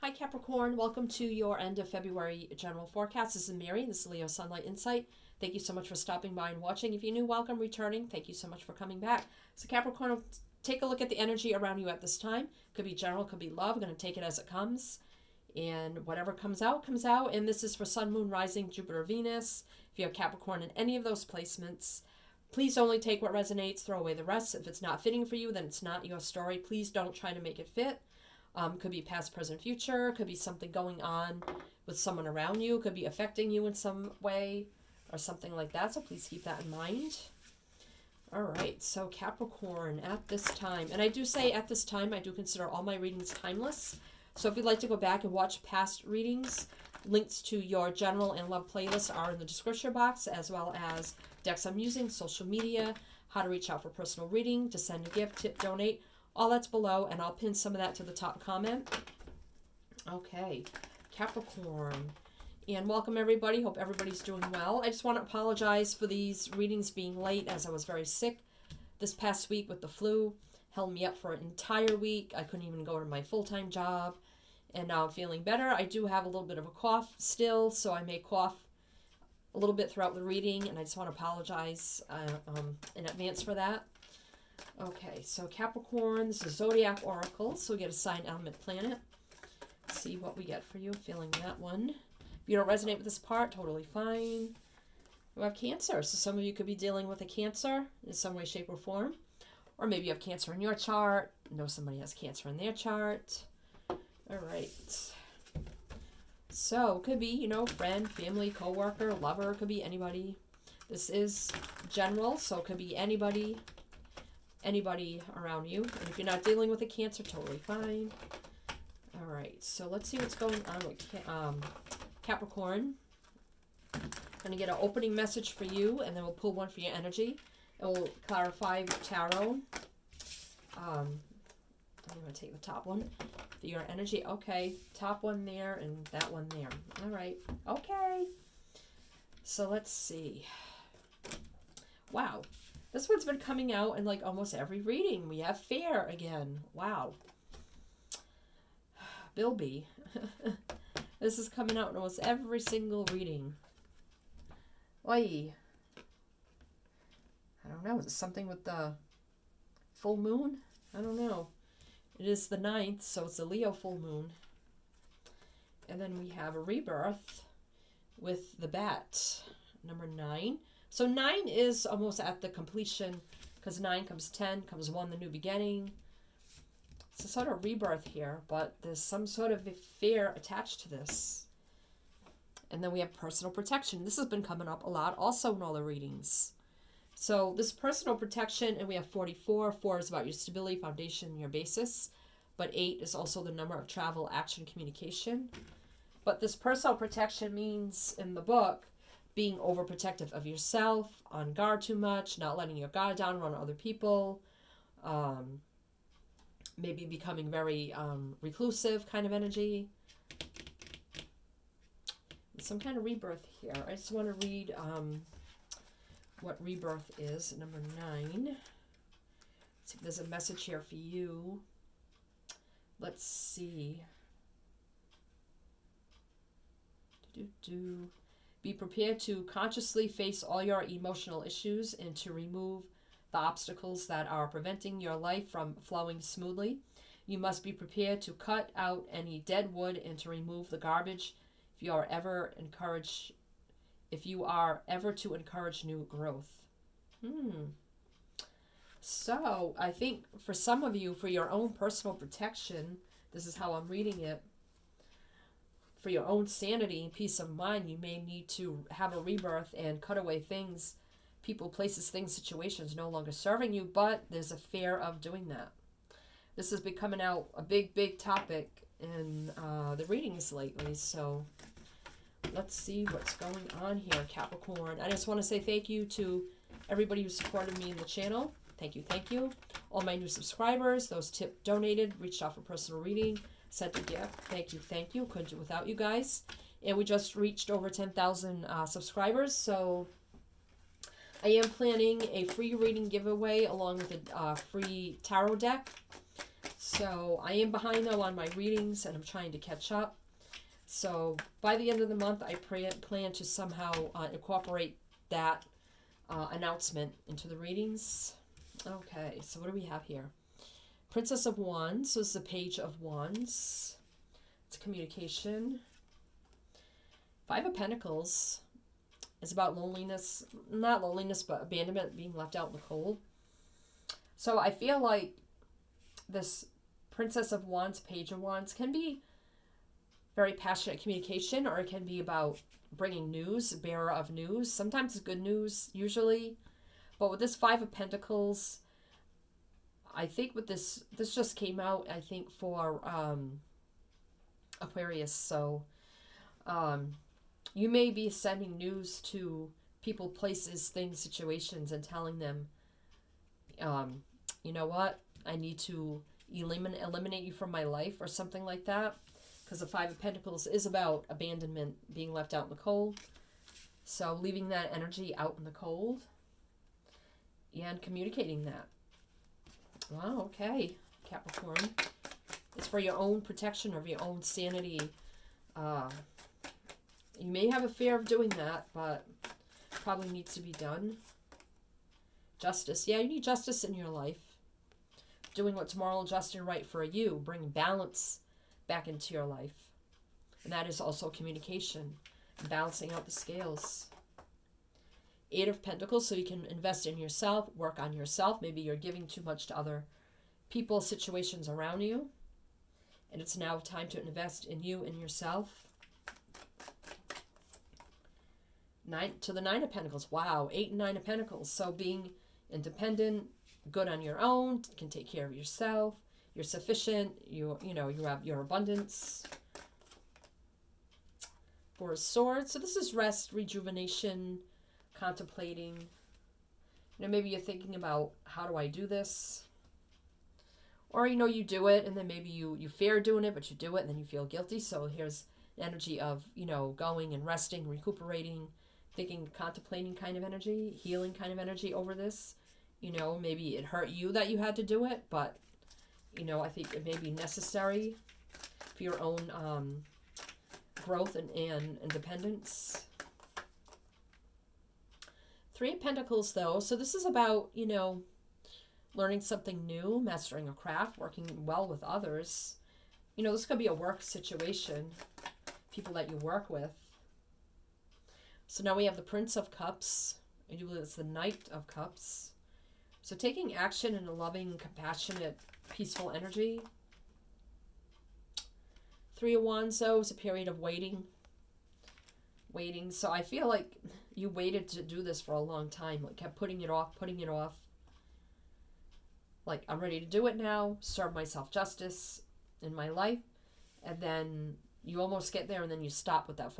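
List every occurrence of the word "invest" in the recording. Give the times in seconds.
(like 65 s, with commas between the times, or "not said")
396 s, 404 s.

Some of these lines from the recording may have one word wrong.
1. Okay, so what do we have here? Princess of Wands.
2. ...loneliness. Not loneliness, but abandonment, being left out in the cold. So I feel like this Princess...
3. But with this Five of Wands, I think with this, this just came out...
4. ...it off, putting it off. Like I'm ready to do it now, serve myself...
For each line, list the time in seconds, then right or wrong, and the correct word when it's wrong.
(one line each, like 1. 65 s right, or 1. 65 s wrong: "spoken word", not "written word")
1. 308 s right
2. 319 s right
3. 337 s wrong: "Pentacles", not "Wands"
4. 486 s right.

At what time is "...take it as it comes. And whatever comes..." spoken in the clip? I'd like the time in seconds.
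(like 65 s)
13 s.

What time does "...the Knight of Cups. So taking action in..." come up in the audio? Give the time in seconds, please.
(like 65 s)
471 s.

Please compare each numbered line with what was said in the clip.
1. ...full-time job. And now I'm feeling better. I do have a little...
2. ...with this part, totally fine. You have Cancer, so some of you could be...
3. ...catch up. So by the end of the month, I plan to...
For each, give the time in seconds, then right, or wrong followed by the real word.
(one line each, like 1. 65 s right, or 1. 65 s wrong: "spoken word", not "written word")
1. 73 s right
2. 92 s right
3. 299 s right.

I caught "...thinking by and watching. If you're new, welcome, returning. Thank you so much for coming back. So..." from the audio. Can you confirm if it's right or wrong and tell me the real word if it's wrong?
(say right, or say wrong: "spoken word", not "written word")
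wrong: "stopping", not "thinking".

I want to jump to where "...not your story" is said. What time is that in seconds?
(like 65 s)
25 s.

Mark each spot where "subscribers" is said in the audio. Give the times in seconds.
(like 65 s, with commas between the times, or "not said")
280 s, 288 s.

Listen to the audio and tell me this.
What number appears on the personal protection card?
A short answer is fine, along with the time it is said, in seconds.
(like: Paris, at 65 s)
44, at 189 s.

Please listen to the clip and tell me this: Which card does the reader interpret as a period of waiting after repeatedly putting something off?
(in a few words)
Three of Wands.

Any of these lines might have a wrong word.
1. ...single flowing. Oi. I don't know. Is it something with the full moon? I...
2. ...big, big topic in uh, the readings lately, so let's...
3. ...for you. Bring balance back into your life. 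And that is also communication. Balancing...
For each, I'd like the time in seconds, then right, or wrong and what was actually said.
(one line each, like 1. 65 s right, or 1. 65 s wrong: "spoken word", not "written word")
1. 152 s wrong: "reading", not "flowing"
2. 267 s right
3. 386 s right.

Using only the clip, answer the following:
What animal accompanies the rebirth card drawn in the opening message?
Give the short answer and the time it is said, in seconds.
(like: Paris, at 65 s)
Bat, at 168 s.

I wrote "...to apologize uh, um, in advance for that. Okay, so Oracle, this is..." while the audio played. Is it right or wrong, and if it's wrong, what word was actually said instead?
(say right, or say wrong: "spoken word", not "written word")
wrong: "Capricorn", not "Oracle".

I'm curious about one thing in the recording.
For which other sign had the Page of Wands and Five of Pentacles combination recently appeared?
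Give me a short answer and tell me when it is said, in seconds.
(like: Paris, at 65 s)
Aquarius, at 344 s.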